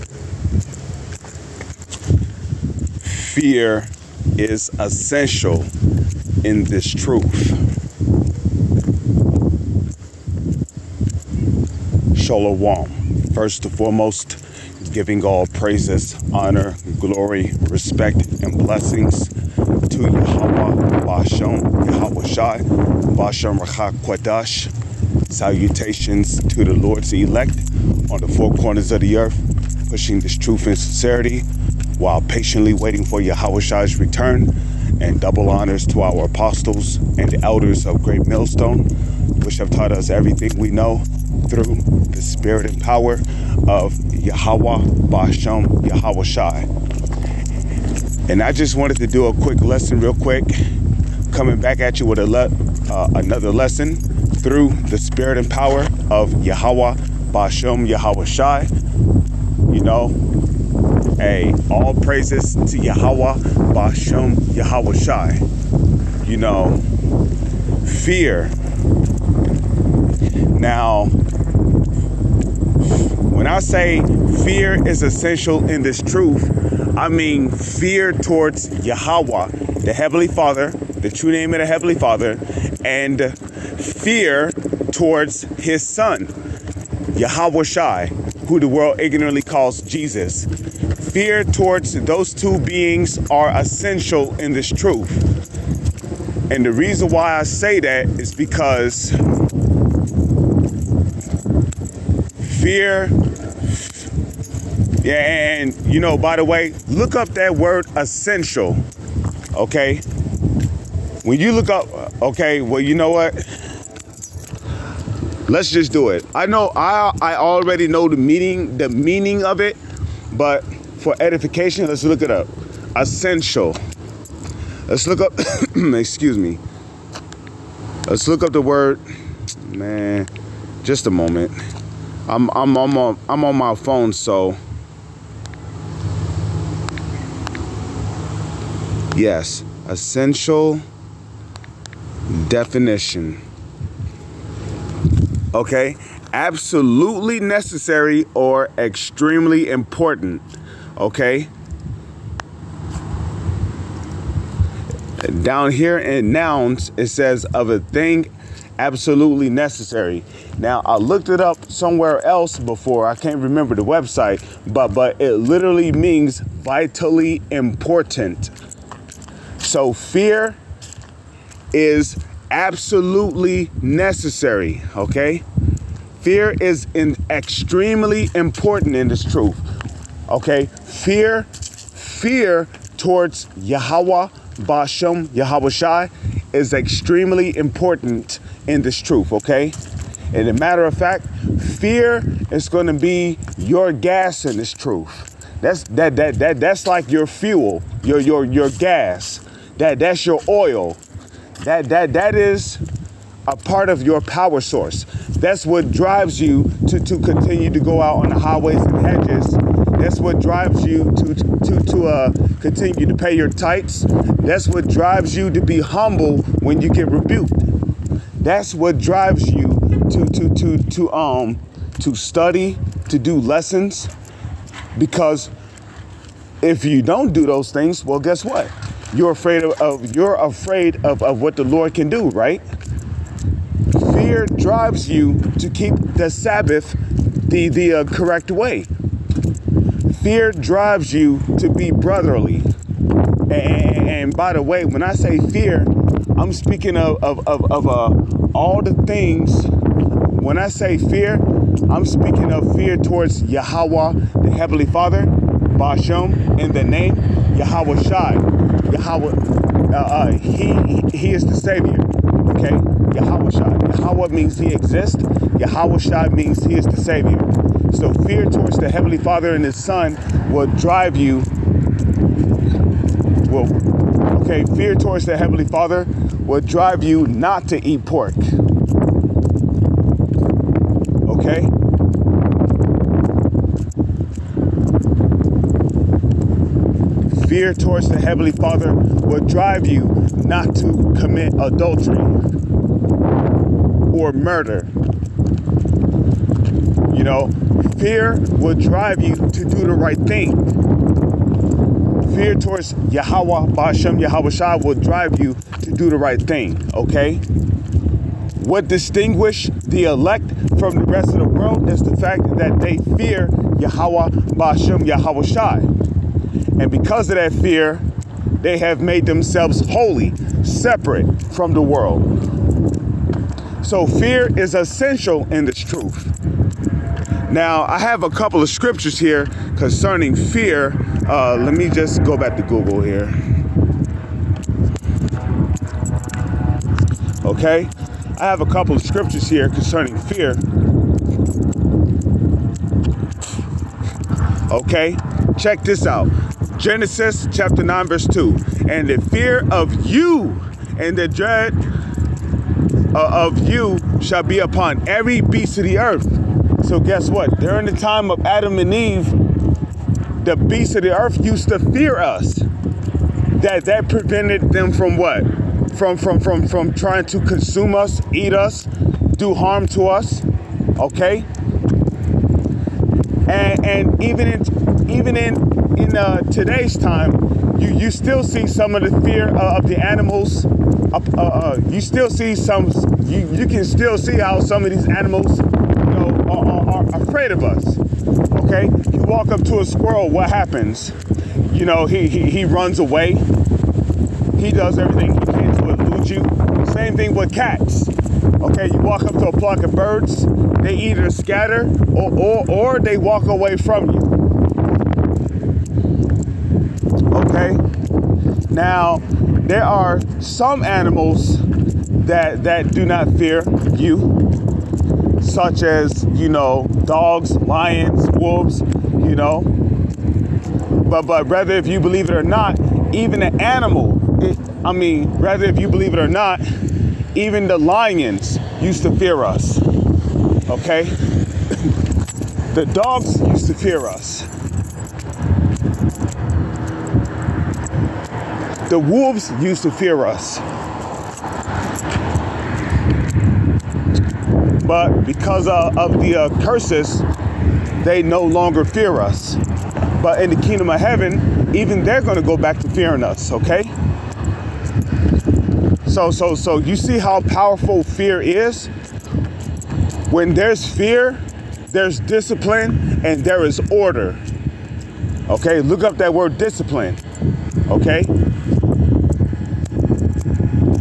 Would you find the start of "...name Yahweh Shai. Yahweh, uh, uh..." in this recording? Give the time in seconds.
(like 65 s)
256 s.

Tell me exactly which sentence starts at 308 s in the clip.
What distinguishes the elect from the rest of the world is the fact that they fear Yahweh, Bashem, Yahweh Shai.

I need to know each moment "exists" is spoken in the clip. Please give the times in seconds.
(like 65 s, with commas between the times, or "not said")
264 s.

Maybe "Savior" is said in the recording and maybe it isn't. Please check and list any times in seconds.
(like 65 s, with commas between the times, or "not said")
261 s, 266 s.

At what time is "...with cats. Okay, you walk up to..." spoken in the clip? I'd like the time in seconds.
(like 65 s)
397 s.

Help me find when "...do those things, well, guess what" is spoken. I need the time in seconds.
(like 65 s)
227 s.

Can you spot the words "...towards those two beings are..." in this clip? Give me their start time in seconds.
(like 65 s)
91 s.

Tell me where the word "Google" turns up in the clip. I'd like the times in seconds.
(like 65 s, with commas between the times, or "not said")
332 s.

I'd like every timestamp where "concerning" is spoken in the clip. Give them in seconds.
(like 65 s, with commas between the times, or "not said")
329 s, 339 s.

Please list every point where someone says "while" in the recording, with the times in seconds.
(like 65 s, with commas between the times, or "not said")
31 s.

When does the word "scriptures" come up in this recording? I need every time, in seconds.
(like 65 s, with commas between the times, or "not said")
328 s, 339 s.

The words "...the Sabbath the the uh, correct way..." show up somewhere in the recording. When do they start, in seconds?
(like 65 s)
236 s.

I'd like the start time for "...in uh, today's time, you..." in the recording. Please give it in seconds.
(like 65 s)
375 s.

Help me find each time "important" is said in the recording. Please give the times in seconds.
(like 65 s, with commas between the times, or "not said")
149 s, 167 s, 178 s, 187 s.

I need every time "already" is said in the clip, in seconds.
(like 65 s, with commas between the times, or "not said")
117 s.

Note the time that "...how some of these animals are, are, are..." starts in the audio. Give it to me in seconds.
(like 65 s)
384 s.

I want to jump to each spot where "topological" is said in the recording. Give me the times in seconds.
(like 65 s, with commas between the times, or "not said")
not said.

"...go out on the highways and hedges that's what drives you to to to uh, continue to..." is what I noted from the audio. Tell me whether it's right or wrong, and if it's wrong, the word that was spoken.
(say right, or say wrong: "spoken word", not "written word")
right.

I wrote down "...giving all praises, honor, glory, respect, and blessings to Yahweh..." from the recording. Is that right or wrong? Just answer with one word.
right.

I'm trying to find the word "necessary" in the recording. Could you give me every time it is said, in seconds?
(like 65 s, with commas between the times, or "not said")
147 s, 159 s, 173 s.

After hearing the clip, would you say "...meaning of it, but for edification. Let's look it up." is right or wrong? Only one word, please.
right.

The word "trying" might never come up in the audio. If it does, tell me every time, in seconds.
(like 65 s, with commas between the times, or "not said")
366 s.